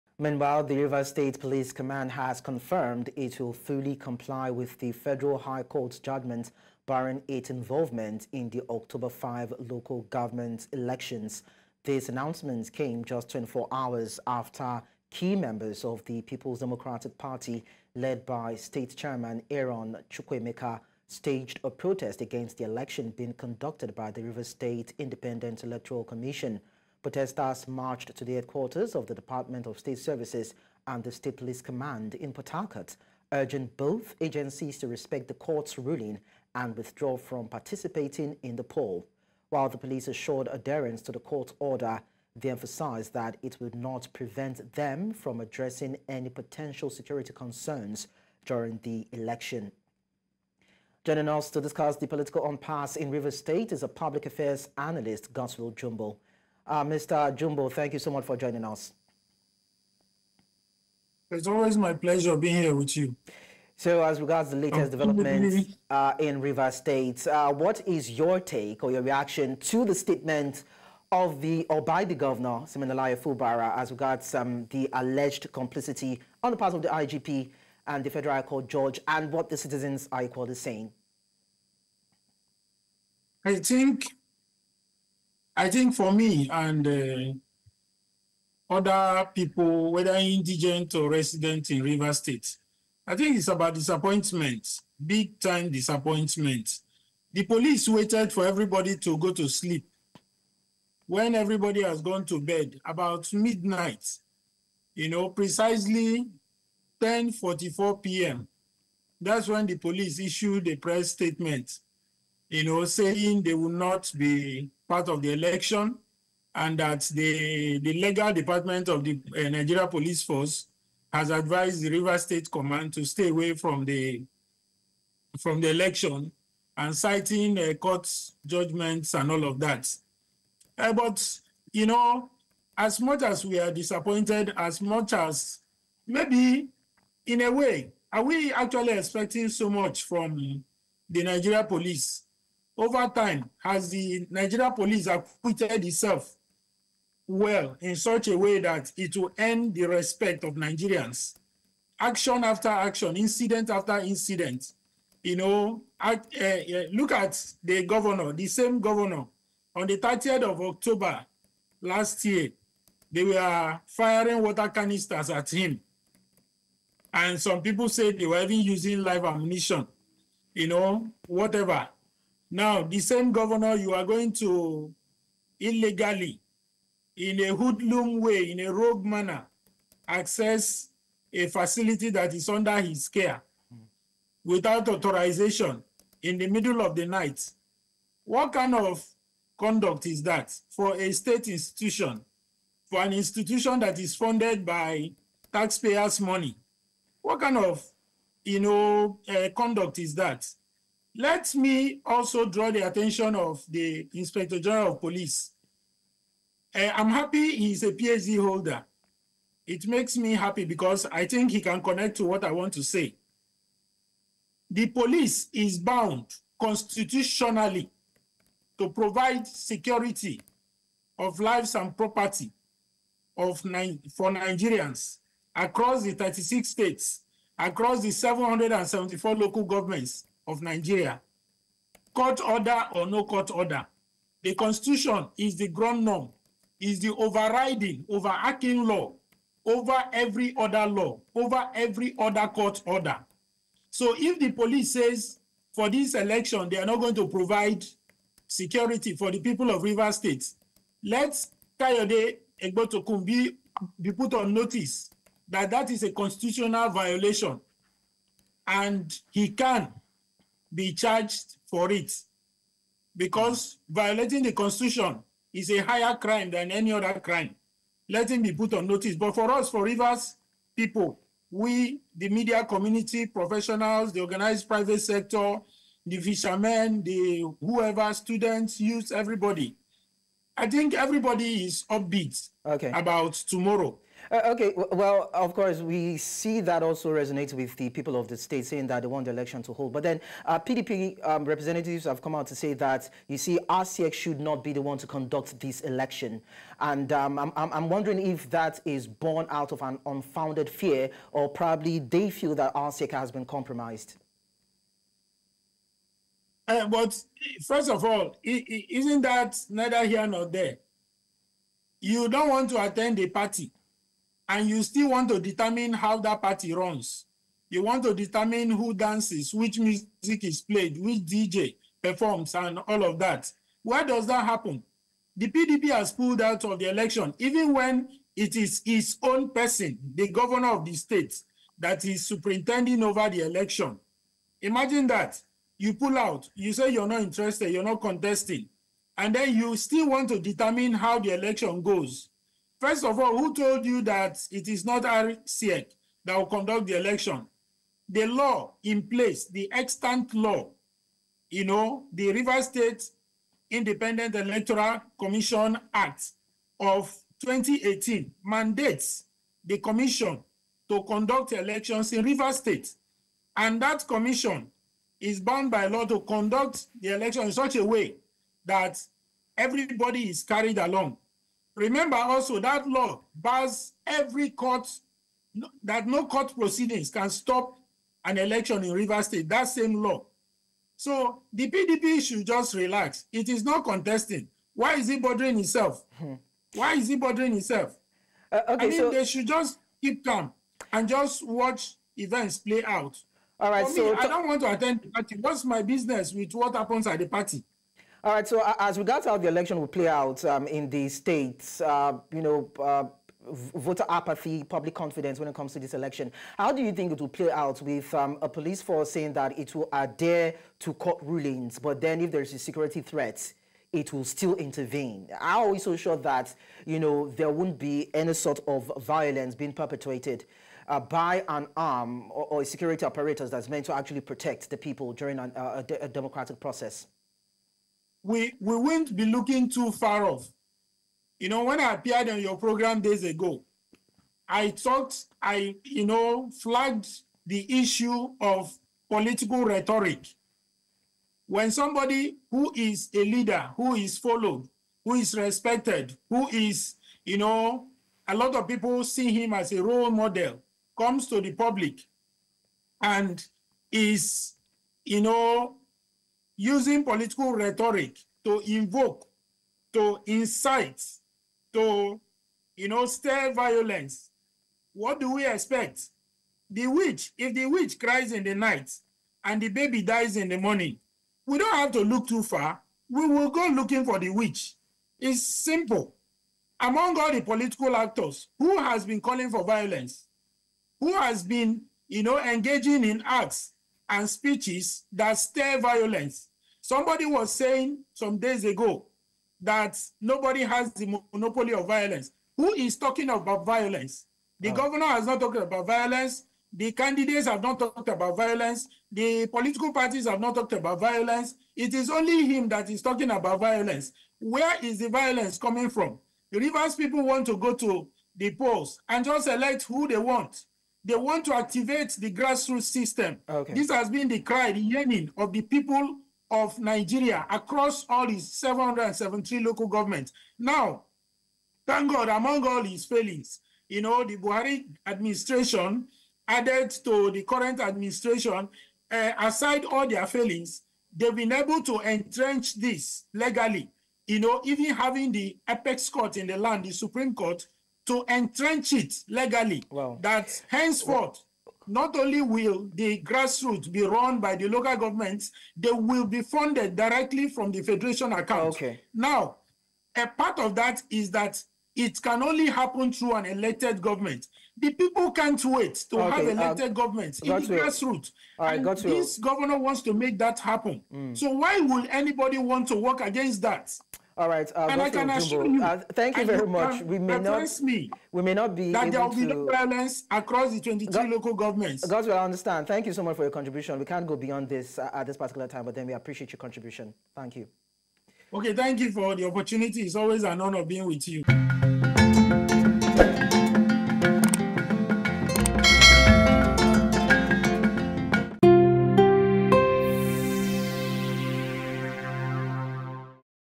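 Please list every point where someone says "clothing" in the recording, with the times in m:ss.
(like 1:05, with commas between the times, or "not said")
not said.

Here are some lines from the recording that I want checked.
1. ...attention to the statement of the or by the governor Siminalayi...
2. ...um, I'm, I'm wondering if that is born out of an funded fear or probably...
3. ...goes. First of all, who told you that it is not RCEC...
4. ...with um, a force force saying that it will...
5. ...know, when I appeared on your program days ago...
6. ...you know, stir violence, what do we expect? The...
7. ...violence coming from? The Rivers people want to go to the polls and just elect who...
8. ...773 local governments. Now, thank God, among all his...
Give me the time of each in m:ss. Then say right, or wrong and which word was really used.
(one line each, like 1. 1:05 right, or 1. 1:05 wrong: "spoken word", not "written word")
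1. 1:09 wrong: "reaction", not "attention"
2. 4:57 wrong: "unfounded", not "funded"
3. 5:41 right
4. 6:47 wrong: "police", not "force"
5. 7:11 right
6. 7:42 right
7. 8:25 right
8. 8:38 right.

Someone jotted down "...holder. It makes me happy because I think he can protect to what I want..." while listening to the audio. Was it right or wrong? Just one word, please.
wrong.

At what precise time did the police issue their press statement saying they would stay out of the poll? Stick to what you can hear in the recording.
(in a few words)
10:44 p.m.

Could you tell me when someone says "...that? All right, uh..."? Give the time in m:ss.
9:23.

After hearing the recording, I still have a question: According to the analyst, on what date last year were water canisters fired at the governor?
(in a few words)
30th of October.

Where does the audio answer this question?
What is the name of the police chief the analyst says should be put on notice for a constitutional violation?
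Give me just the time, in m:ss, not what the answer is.
4:11.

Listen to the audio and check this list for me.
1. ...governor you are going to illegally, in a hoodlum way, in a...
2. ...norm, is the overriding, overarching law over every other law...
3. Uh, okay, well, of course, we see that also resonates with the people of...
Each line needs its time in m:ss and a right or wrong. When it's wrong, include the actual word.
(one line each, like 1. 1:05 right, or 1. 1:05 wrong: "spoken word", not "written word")
1. 2:53 right
2. 3:56 right
3. 4:44 right.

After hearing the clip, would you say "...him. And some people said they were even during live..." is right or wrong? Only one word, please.
wrong.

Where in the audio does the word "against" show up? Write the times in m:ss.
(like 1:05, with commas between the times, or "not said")
0:22, 9:23.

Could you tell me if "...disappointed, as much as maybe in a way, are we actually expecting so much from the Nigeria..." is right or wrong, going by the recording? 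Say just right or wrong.
right.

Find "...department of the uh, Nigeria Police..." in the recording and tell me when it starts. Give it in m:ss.
1:58.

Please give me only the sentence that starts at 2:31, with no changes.
Action after action, incident after incident.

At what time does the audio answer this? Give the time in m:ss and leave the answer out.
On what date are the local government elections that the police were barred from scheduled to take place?
0:08.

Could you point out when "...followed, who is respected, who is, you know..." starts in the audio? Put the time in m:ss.
7:24.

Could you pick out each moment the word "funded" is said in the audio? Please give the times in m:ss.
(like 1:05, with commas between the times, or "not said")
3:14, 9:06.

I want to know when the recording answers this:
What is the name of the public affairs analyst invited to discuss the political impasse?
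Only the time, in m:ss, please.
0:55.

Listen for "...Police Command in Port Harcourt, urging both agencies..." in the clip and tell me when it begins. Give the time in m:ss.
0:31.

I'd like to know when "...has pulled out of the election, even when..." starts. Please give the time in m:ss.
5:25.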